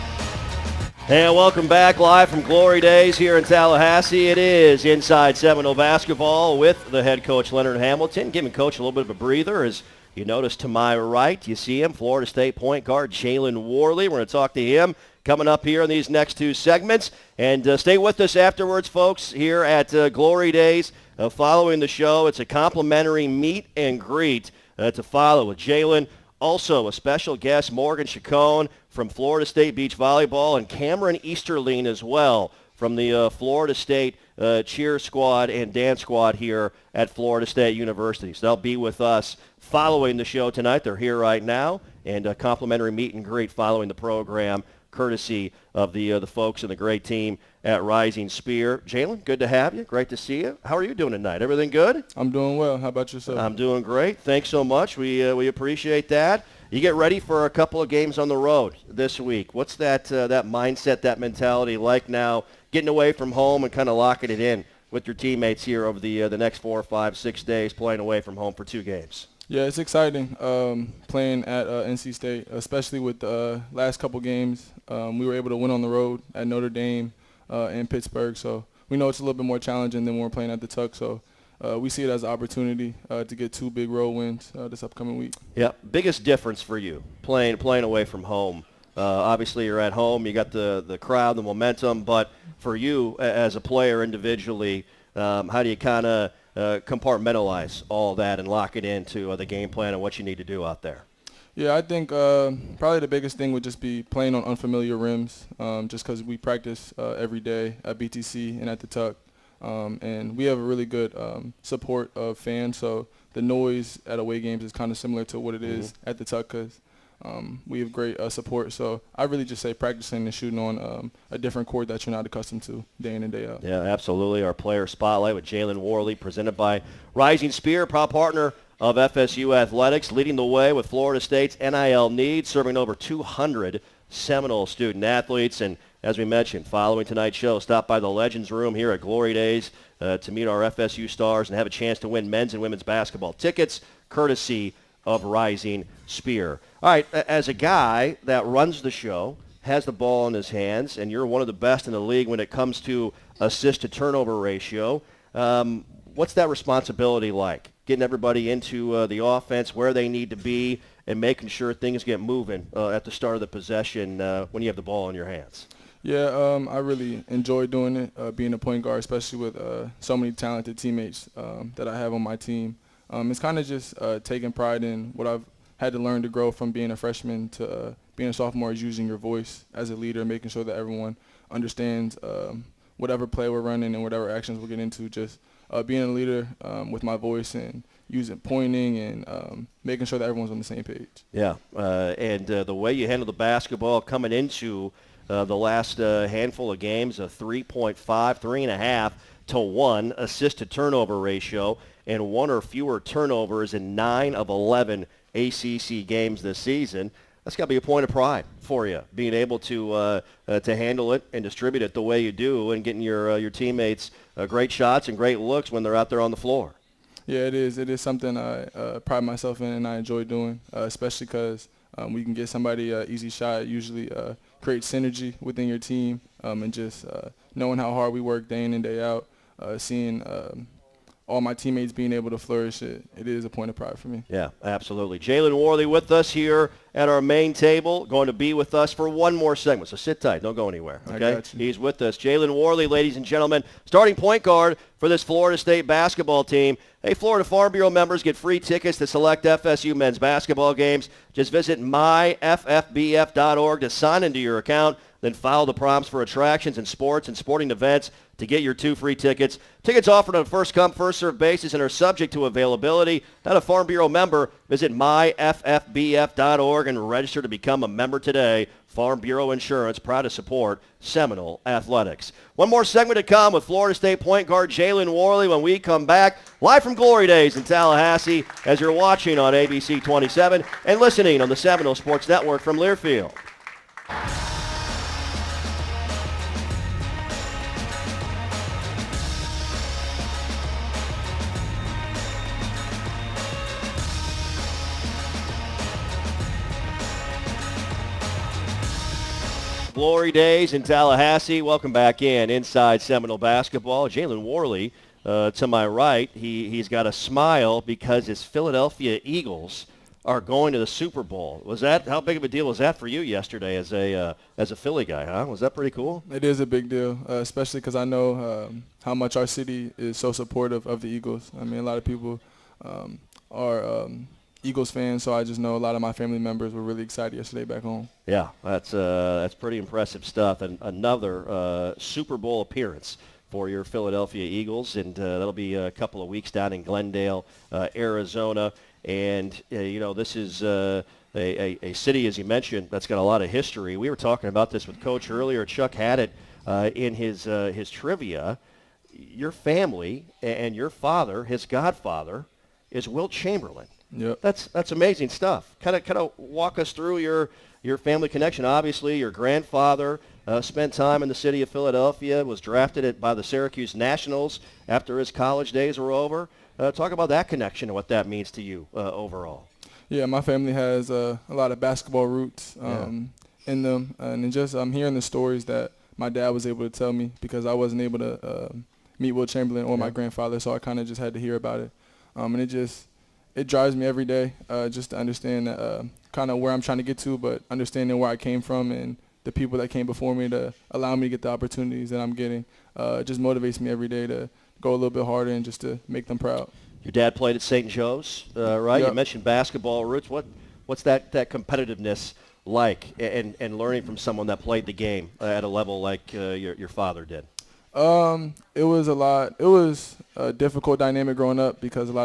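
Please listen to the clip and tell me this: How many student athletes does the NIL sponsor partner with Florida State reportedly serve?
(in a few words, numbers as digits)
Over 200.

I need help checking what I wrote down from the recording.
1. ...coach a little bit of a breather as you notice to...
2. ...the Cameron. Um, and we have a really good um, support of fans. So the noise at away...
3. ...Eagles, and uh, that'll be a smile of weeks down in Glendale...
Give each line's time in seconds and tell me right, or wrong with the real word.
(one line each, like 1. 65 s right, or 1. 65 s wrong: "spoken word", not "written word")
1. 8 s right
2. 108 s wrong: "Tuck", not "Cameron"
3. 334 s wrong: "couple", not "smile".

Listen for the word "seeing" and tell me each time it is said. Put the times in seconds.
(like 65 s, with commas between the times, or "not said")
229 s.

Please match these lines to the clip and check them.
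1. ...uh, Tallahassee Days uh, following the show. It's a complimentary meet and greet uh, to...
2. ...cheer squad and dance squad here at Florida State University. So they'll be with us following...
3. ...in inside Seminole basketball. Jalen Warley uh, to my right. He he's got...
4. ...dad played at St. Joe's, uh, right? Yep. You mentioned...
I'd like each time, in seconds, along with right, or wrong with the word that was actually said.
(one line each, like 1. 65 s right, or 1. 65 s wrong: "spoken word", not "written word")
1. 19 s wrong: "Glory", not "Tallahassee"
2. 34 s right
3. 302 s right
4. 397 s right.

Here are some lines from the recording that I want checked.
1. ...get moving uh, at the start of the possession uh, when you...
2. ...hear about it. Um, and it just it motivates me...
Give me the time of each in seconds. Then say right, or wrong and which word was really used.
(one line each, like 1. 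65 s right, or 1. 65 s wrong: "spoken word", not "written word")
1. 162 s right
2. 381 s wrong: "drives", not "motivates".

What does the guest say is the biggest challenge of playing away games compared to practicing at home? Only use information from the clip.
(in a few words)
Unfamiliar rims.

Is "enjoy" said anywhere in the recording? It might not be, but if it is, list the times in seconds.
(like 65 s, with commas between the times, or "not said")
167 s, 219 s.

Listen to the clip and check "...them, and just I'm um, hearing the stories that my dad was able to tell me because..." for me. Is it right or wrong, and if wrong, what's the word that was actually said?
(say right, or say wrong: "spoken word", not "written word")
right.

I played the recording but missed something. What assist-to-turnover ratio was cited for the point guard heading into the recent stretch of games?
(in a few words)
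3.5 to 1.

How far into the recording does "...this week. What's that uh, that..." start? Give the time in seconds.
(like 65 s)
58 s.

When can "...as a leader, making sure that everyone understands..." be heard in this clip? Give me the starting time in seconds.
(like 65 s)
179 s.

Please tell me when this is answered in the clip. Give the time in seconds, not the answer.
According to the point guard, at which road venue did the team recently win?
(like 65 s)
76 s.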